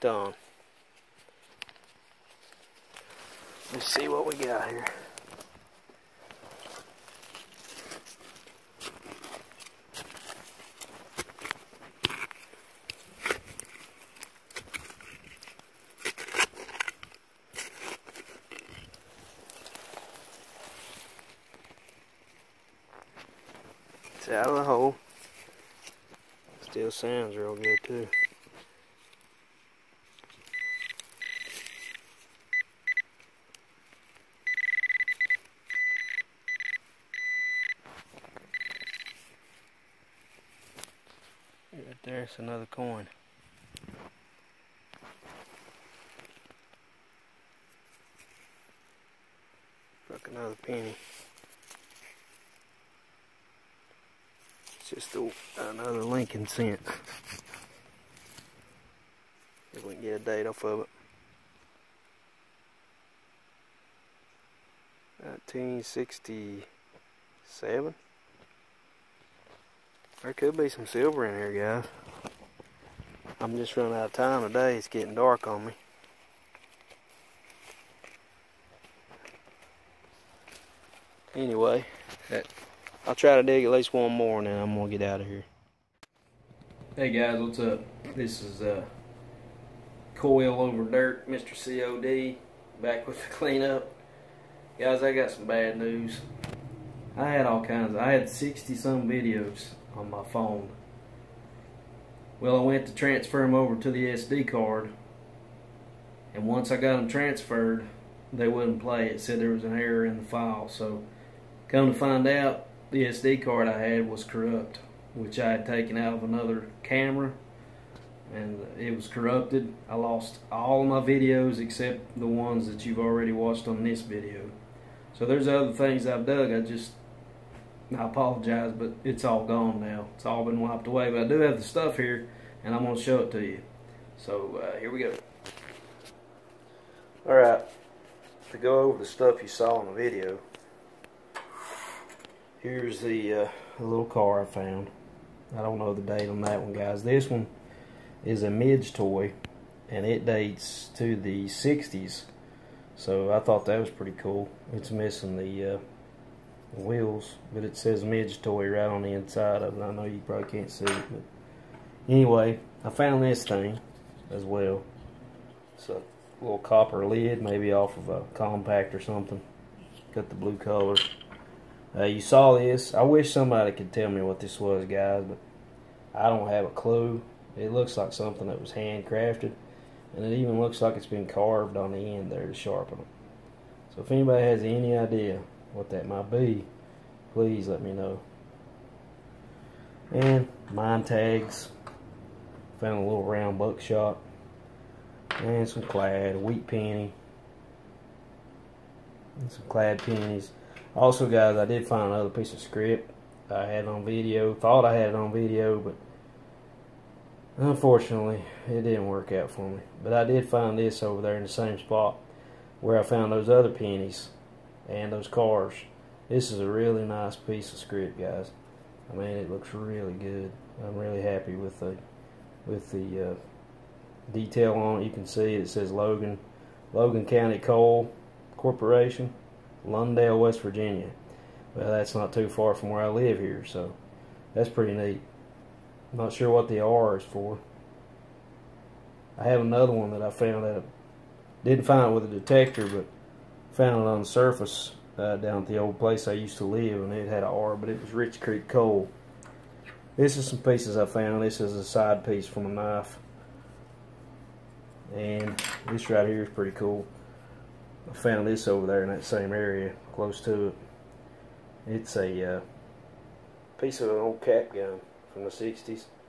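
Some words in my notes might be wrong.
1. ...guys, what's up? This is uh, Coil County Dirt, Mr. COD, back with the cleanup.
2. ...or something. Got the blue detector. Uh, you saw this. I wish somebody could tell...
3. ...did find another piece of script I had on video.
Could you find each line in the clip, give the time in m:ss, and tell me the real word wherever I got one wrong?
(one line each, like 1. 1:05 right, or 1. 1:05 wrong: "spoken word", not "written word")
1. 1:27 wrong: "Over", not "County"
2. 2:48 wrong: "color", not "detector"
3. 3:21 right.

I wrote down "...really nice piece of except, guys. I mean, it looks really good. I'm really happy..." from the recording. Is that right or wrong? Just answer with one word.
wrong.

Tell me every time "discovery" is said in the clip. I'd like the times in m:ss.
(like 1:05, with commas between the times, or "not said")
not said.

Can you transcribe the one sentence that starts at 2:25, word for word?
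I don't know the date on that one, guys.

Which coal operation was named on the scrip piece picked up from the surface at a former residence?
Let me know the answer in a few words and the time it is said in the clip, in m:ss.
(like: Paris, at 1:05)
Rich Creek coal, at 4:08.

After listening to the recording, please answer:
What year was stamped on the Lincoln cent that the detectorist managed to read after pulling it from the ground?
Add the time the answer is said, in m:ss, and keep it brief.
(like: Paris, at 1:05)
1967, at 1:05.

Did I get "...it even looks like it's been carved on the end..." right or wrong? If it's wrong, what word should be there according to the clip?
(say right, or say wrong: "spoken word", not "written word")
right.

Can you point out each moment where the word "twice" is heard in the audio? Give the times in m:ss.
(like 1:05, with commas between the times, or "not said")
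not said.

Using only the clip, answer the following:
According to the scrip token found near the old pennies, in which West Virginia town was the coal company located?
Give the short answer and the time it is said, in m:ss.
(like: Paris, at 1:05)
Lundale, at 3:49.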